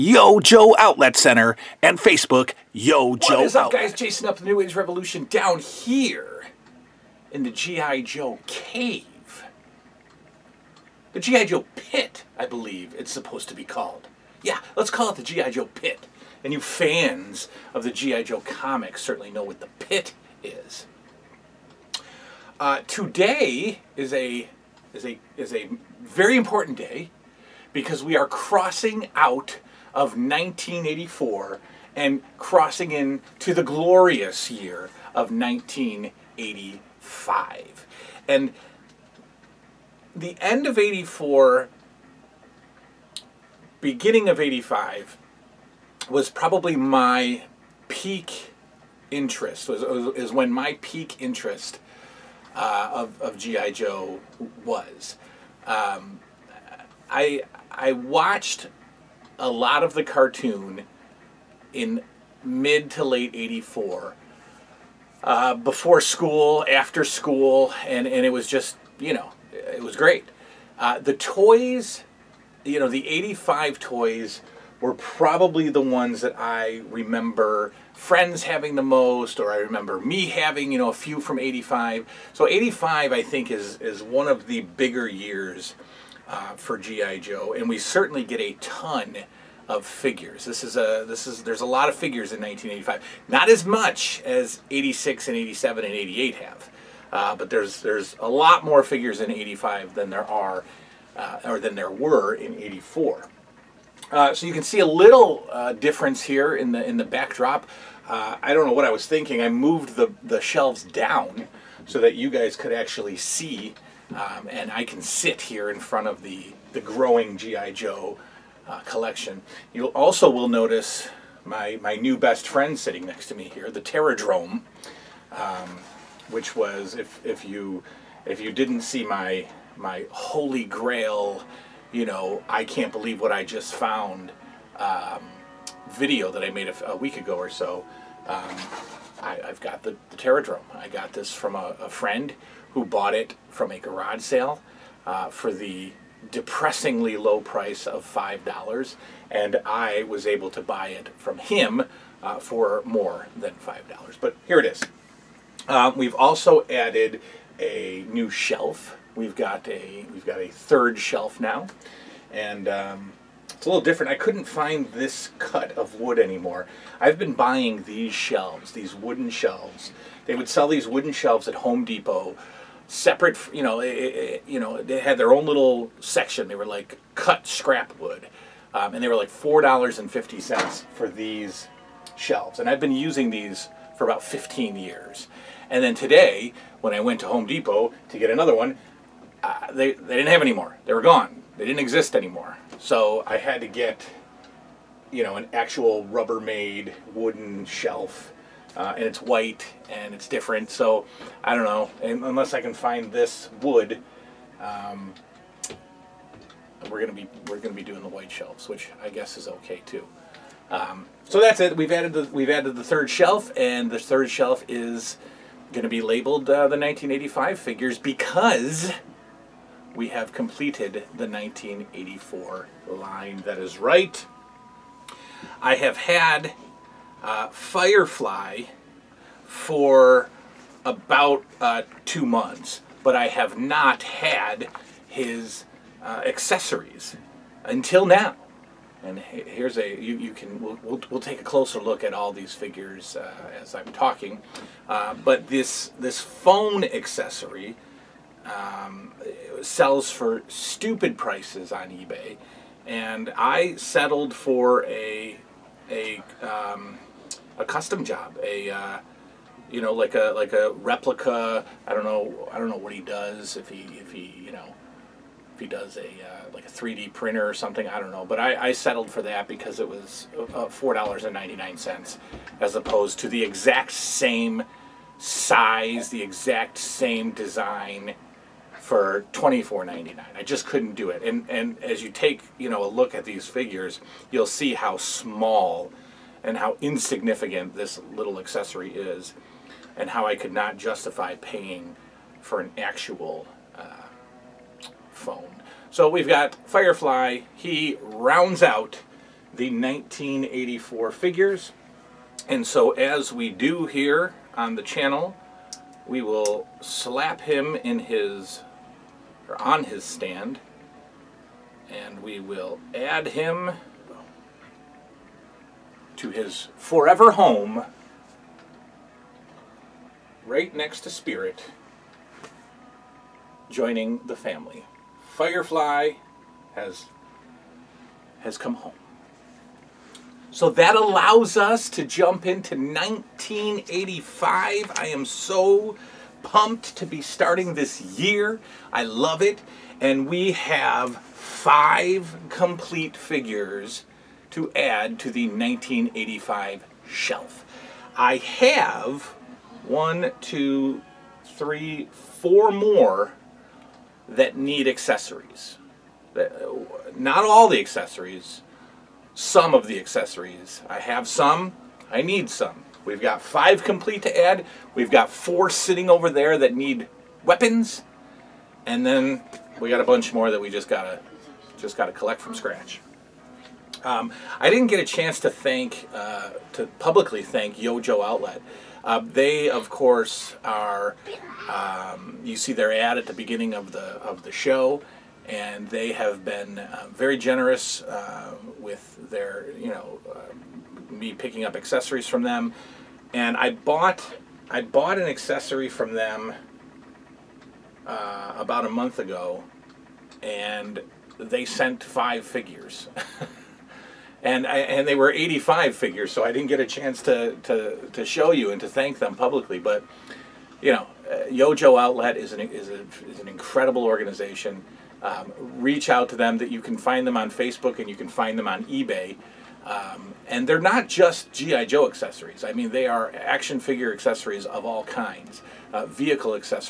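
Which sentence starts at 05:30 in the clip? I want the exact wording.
So that allows us to jump into 1985.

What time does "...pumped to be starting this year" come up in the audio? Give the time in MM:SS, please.
05:36.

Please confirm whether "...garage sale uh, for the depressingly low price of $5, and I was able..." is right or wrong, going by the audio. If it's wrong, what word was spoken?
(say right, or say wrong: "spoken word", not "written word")
right.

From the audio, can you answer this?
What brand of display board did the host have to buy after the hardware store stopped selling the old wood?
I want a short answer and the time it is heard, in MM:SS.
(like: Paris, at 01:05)
Rubbermaid, at 03:16.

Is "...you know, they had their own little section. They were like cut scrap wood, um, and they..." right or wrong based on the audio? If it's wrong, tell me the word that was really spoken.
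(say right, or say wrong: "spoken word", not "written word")
right.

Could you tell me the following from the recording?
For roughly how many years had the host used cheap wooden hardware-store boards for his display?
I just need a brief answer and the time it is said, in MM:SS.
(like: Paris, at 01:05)
15, at 03:04.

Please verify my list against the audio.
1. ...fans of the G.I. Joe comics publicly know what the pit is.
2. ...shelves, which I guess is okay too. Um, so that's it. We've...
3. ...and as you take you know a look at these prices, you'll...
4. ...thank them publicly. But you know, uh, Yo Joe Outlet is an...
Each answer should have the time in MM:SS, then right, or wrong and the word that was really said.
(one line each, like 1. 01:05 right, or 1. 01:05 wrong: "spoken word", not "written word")
1. 00:16 wrong: "certainly", not "publicly"
2. 03:28 right
3. 04:41 wrong: "figures", not "prices"
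4. 06:48 right.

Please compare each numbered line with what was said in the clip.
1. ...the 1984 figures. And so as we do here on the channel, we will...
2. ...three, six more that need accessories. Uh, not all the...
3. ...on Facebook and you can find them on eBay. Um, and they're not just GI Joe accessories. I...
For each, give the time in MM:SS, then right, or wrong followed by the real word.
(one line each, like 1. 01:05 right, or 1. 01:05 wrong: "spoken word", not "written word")
1. 04:59 right
2. 05:51 wrong: "four", not "six"
3. 06:57 right.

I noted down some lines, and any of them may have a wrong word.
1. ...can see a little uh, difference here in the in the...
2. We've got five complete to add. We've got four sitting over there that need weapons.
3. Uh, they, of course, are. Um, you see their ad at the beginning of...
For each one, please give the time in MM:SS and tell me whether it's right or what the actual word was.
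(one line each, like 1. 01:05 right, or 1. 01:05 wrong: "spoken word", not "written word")
1. 01:44 right
2. 06:03 right
3. 06:19 right.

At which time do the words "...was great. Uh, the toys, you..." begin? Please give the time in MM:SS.
01:09.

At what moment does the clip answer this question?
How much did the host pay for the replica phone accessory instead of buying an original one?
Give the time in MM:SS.
04:30.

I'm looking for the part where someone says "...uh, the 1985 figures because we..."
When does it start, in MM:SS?
03:36.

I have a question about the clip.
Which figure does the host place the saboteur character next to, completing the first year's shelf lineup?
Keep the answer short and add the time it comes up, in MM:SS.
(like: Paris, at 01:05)
Spirit, at 05:21.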